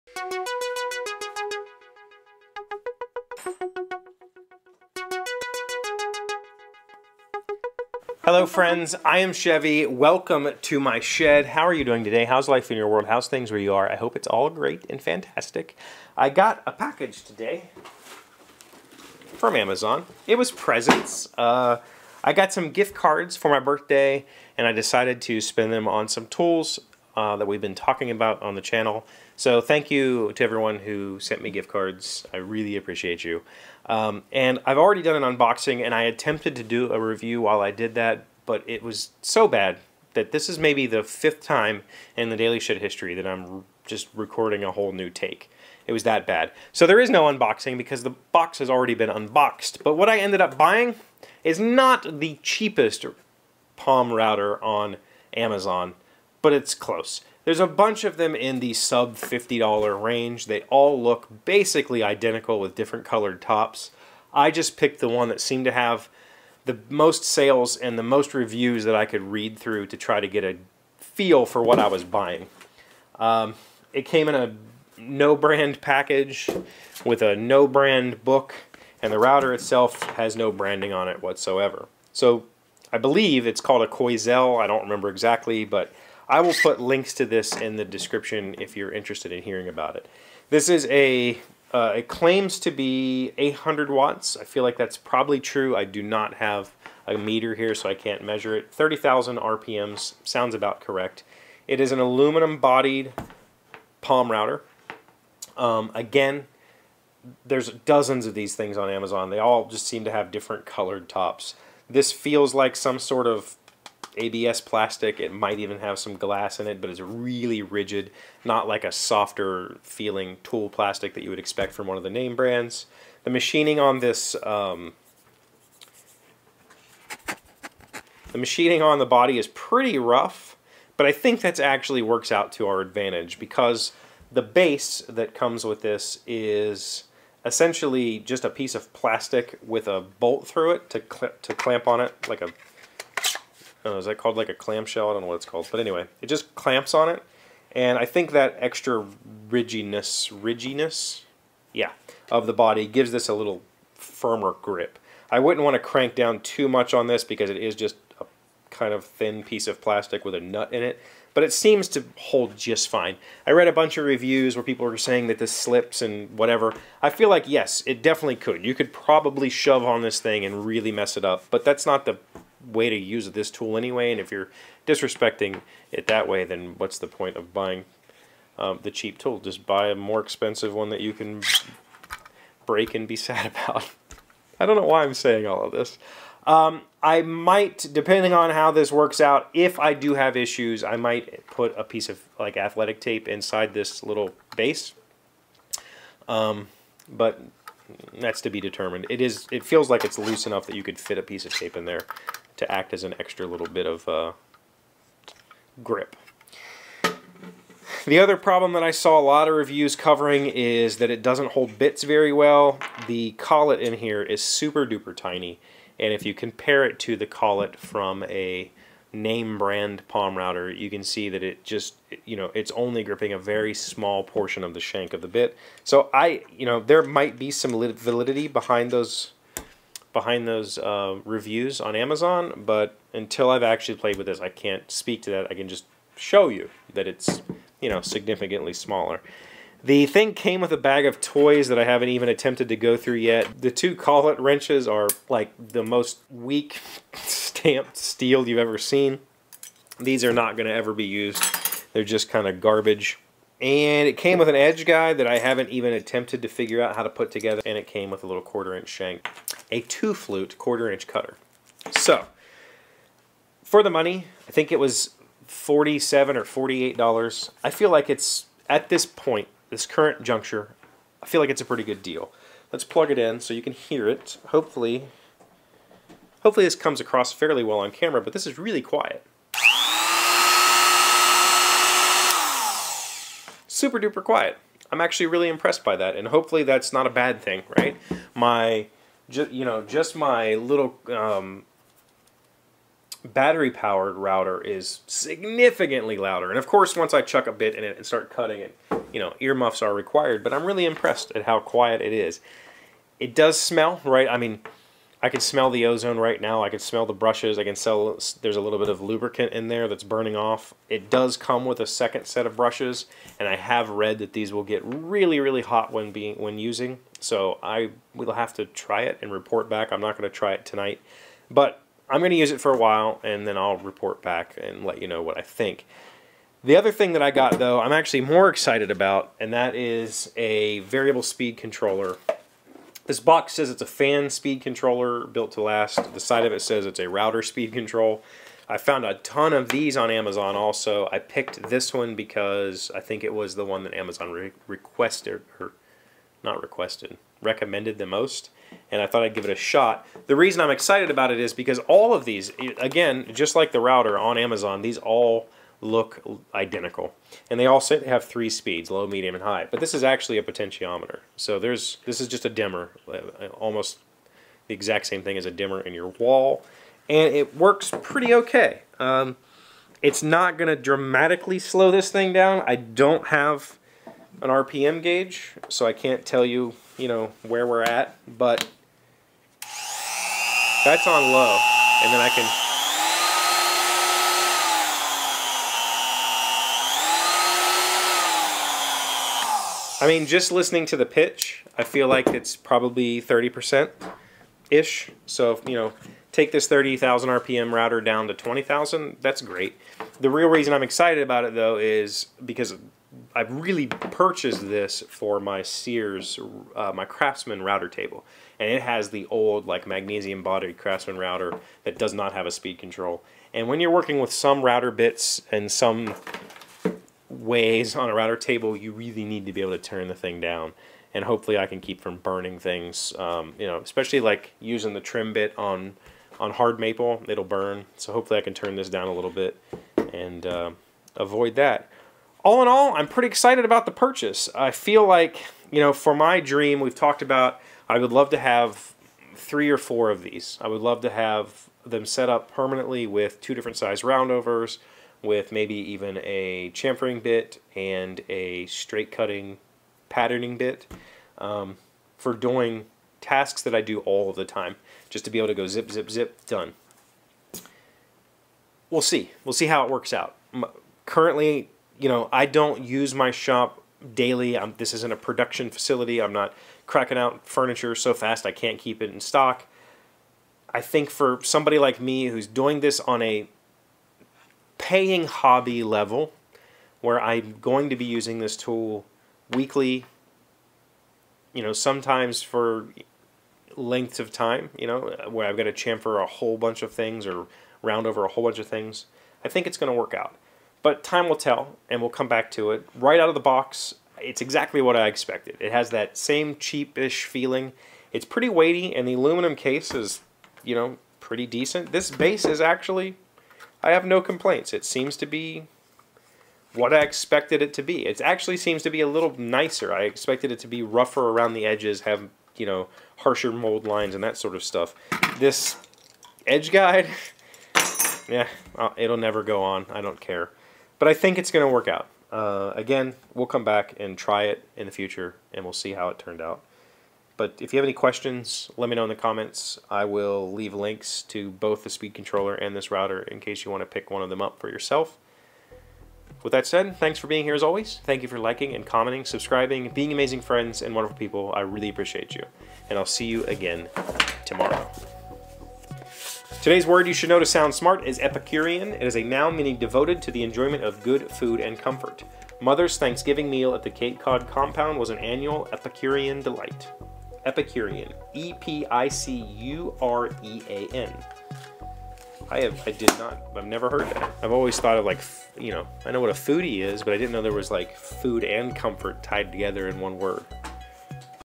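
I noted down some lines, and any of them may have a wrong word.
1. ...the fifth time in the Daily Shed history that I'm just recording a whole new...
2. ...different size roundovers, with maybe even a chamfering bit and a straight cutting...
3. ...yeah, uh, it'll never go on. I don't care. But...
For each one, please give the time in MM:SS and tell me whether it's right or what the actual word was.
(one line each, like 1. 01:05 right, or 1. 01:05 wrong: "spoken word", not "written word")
1. 00:40 right
2. 07:23 right
3. 08:38 right.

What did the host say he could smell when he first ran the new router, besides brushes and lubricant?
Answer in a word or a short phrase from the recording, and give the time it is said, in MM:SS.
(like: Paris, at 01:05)
ozone, at 05:05.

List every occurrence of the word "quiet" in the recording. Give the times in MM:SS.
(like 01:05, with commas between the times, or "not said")
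04:38, 04:44, 05:01.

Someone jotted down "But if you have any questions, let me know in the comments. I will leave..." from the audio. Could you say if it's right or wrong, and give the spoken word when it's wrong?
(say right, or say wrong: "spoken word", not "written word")
right.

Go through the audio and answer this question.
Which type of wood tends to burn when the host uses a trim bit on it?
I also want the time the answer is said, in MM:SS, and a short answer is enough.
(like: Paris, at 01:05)
hard maple, at 07:06.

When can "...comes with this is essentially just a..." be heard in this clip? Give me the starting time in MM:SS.
02:15.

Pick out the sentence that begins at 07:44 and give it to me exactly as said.
I'm, this isn't a production facility.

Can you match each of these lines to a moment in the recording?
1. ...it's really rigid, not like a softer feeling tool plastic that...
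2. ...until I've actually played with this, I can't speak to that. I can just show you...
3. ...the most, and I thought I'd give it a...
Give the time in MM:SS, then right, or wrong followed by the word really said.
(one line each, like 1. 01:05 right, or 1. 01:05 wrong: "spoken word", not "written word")
1. 01:56 right
2. 03:53 right
3. 05:47 right.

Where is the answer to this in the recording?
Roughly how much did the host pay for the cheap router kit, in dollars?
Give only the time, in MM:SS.
04:25.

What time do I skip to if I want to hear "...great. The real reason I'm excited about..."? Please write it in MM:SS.
06:39.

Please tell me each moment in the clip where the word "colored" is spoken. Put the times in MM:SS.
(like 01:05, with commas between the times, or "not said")
01:03, 01:50.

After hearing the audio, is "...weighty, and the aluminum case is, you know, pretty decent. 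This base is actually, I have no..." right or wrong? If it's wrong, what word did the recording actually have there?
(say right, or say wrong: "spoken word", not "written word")
right.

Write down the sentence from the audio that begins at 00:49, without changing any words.
But what I ended up buying is not the cheapest Palm router on Amazon but it's close.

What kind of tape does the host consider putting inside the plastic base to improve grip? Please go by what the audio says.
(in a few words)
athletic tape.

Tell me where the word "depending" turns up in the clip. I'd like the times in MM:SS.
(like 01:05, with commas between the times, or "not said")
03:07.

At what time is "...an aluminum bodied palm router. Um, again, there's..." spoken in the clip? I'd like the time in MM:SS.
01:41.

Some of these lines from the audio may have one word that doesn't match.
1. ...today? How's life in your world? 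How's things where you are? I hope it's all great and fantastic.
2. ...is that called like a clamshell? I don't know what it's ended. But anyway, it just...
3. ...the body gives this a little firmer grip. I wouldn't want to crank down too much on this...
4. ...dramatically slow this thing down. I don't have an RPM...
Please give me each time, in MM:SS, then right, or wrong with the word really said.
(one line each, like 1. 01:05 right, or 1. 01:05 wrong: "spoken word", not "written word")
1. 00:12 right
2. 02:23 wrong: "called", not "ended"
3. 02:32 right
4. 06:10 right.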